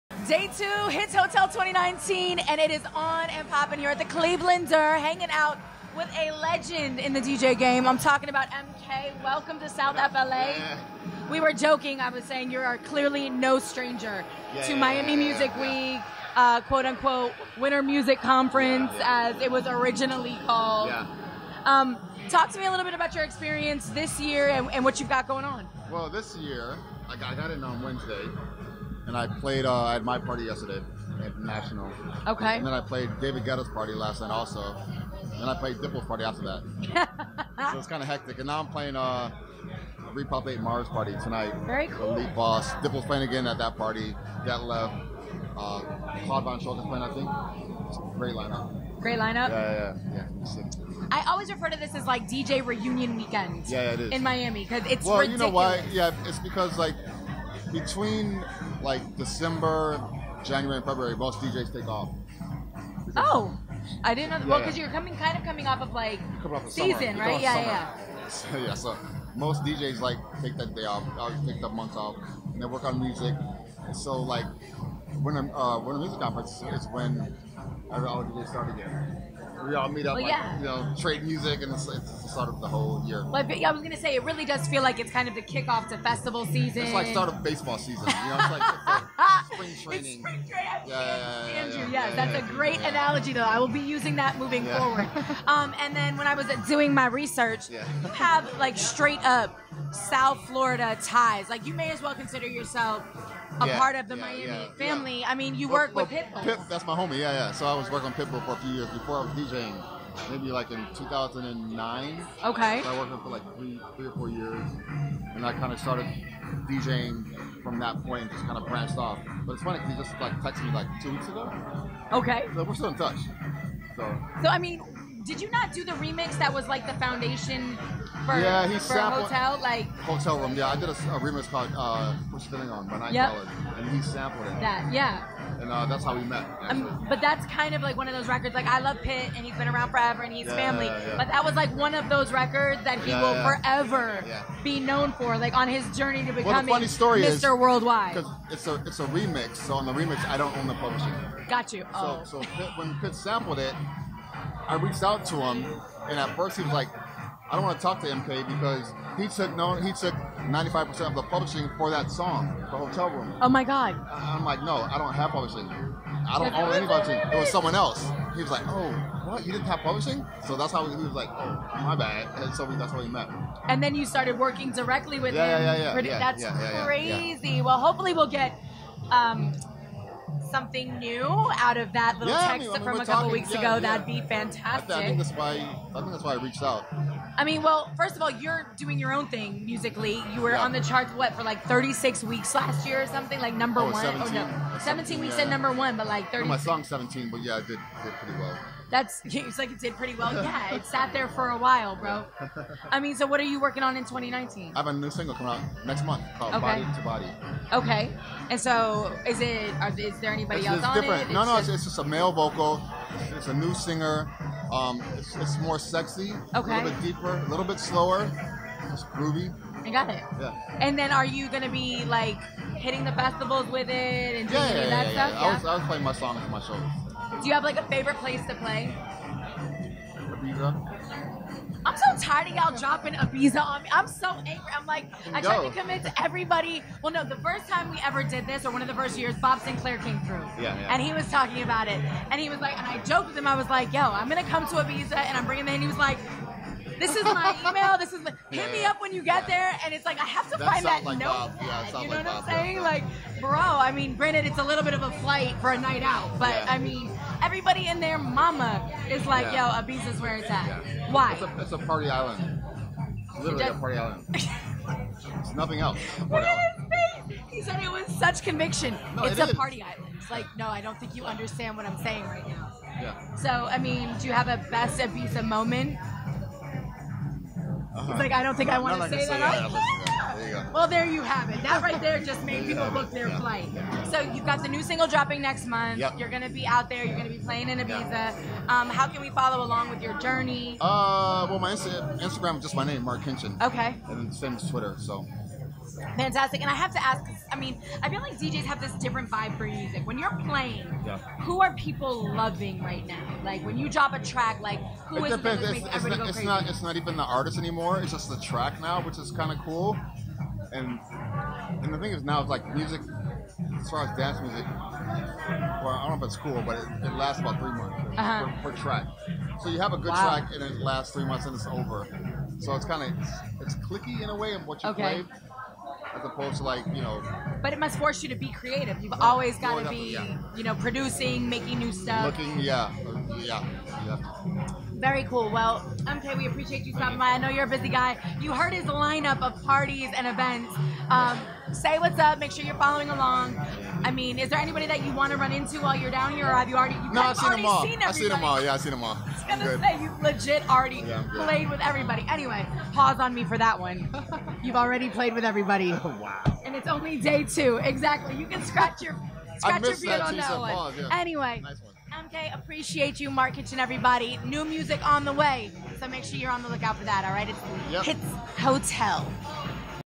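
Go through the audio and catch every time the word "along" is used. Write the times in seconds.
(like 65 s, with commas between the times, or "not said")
289 s, 343 s.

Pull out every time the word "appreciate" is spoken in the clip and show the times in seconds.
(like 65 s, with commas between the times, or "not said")
336 s, 362 s.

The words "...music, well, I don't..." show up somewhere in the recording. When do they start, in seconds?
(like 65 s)
314 s.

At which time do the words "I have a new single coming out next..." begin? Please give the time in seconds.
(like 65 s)
204 s.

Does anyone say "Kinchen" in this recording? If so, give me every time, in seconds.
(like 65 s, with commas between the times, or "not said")
293 s.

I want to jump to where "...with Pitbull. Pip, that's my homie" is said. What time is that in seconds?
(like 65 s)
106 s.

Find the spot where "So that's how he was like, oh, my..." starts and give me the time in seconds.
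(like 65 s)
170 s.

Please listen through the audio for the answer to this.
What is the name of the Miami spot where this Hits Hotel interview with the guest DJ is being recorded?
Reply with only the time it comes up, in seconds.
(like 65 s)
4 s.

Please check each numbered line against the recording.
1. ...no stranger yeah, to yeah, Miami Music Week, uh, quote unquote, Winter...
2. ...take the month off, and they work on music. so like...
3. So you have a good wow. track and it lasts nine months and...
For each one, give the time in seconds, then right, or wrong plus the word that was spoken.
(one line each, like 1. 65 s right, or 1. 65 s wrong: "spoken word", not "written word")
1. 13 s right
2. 71 s right
3. 319 s wrong: "three", not "nine".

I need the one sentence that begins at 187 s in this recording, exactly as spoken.
I mean, well, first of all, you're doing your own thing musically.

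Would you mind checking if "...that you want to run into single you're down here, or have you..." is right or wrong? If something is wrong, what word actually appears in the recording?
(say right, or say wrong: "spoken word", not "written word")
wrong: "while", not "single".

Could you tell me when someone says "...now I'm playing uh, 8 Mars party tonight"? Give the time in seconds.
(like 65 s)
38 s.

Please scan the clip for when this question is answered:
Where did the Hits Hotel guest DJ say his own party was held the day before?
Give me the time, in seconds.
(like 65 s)
31 s.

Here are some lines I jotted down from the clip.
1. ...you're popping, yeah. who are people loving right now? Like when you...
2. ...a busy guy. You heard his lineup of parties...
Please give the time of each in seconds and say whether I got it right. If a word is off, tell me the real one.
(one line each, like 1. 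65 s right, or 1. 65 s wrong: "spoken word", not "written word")
1. 300 s wrong: "playing", not "popping"
2. 337 s right.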